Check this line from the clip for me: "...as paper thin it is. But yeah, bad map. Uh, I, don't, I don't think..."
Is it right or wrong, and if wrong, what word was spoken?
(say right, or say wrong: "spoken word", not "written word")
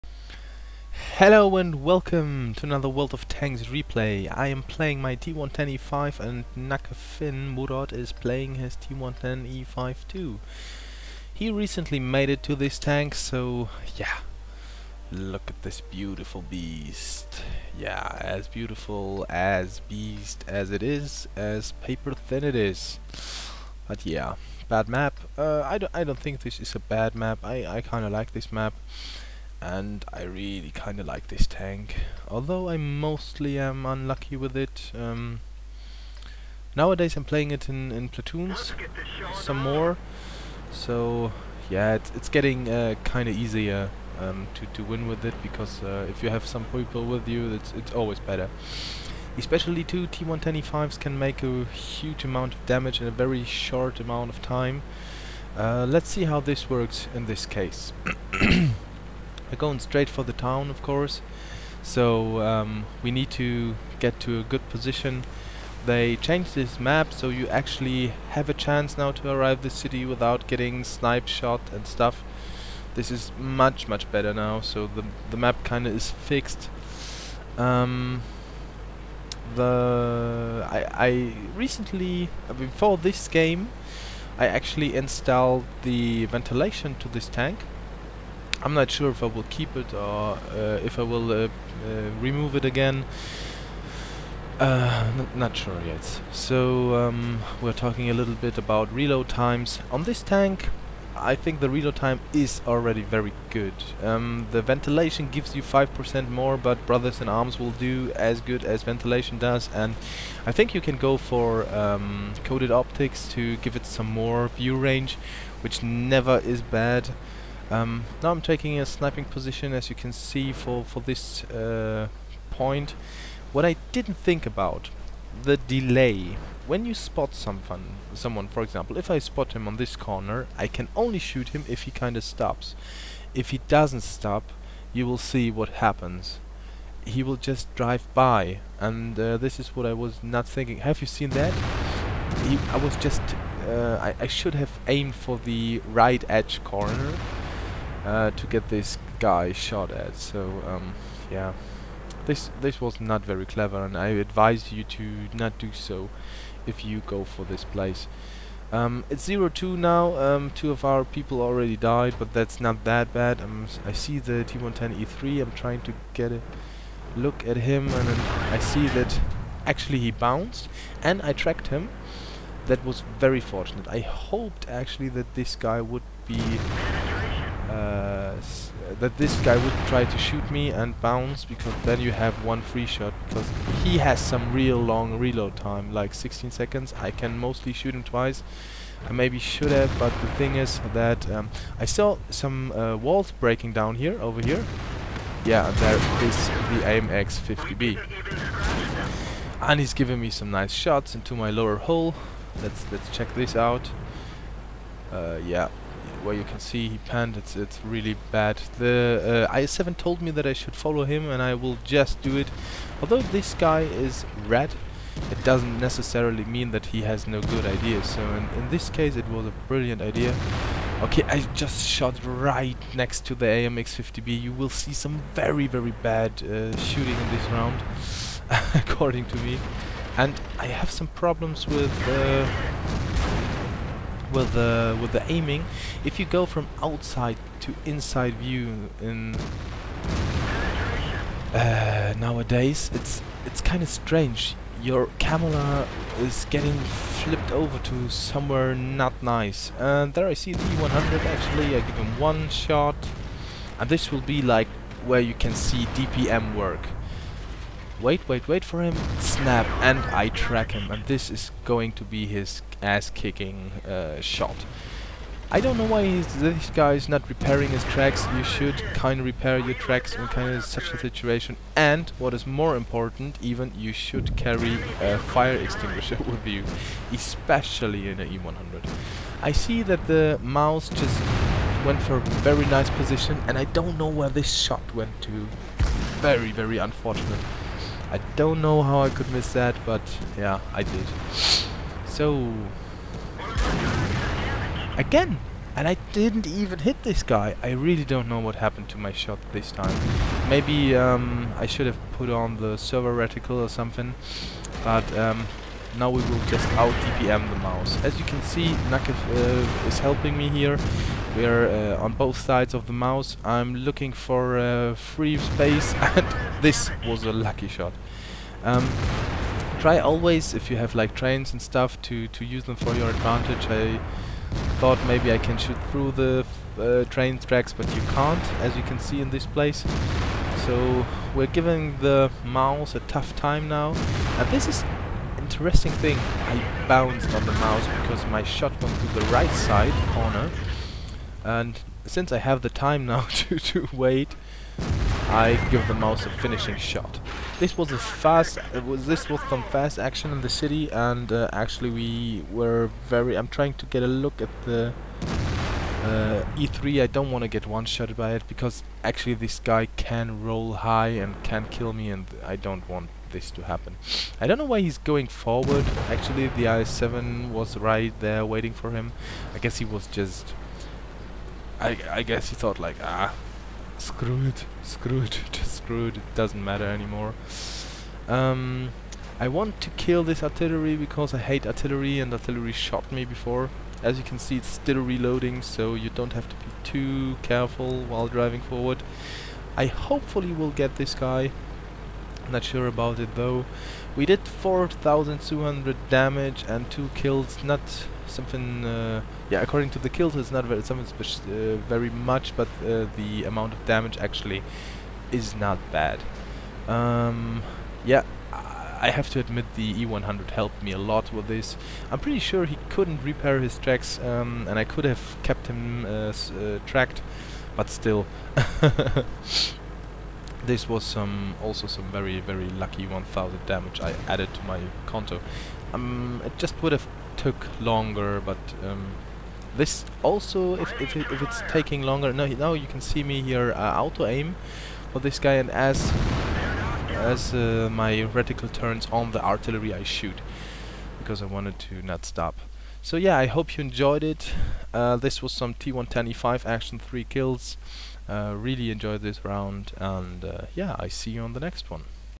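right.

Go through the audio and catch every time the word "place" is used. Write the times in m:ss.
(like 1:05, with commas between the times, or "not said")
2:37, 5:29.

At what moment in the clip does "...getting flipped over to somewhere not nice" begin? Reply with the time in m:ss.
4:06.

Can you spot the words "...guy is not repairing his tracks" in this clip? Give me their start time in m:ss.
4:26.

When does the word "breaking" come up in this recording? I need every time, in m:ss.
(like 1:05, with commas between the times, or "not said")
3:13.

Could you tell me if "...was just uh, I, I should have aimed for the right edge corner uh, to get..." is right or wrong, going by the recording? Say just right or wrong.
right.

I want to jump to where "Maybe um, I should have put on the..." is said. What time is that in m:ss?
5:00.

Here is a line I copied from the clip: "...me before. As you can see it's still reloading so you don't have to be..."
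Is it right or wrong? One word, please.
right.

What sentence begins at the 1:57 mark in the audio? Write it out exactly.
Um, now I'm taking a sniping position as you can see for, for this uh, point.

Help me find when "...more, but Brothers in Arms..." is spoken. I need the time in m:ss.
1:46.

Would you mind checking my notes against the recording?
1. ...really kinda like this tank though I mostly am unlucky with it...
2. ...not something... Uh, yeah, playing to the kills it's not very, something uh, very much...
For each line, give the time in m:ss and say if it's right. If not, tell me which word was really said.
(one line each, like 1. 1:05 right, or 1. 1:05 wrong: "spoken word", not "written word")
1. 0:30 wrong: "although", not "though"
2. 6:37 wrong: "according", not "playing".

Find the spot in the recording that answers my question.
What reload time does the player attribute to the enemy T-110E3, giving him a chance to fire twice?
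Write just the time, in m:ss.
3:06.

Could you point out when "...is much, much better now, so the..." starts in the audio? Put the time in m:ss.
1:13.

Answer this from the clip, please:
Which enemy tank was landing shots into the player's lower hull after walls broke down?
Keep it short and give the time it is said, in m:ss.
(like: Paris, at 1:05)
AMX 50B, at 3:16.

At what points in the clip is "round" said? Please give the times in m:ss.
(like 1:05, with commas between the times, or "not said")
3:47, 7:29.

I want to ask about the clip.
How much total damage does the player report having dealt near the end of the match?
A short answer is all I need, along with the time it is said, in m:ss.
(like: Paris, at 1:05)
4,200, at 6:34.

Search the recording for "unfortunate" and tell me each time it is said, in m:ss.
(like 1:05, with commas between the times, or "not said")
4:46.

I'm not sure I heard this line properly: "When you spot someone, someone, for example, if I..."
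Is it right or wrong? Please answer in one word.
right.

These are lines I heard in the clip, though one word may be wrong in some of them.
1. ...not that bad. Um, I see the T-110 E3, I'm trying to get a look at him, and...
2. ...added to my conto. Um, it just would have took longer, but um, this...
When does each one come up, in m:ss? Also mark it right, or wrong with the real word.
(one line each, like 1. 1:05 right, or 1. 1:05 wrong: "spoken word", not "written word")
1. 2:42 right
2. 7:04 right.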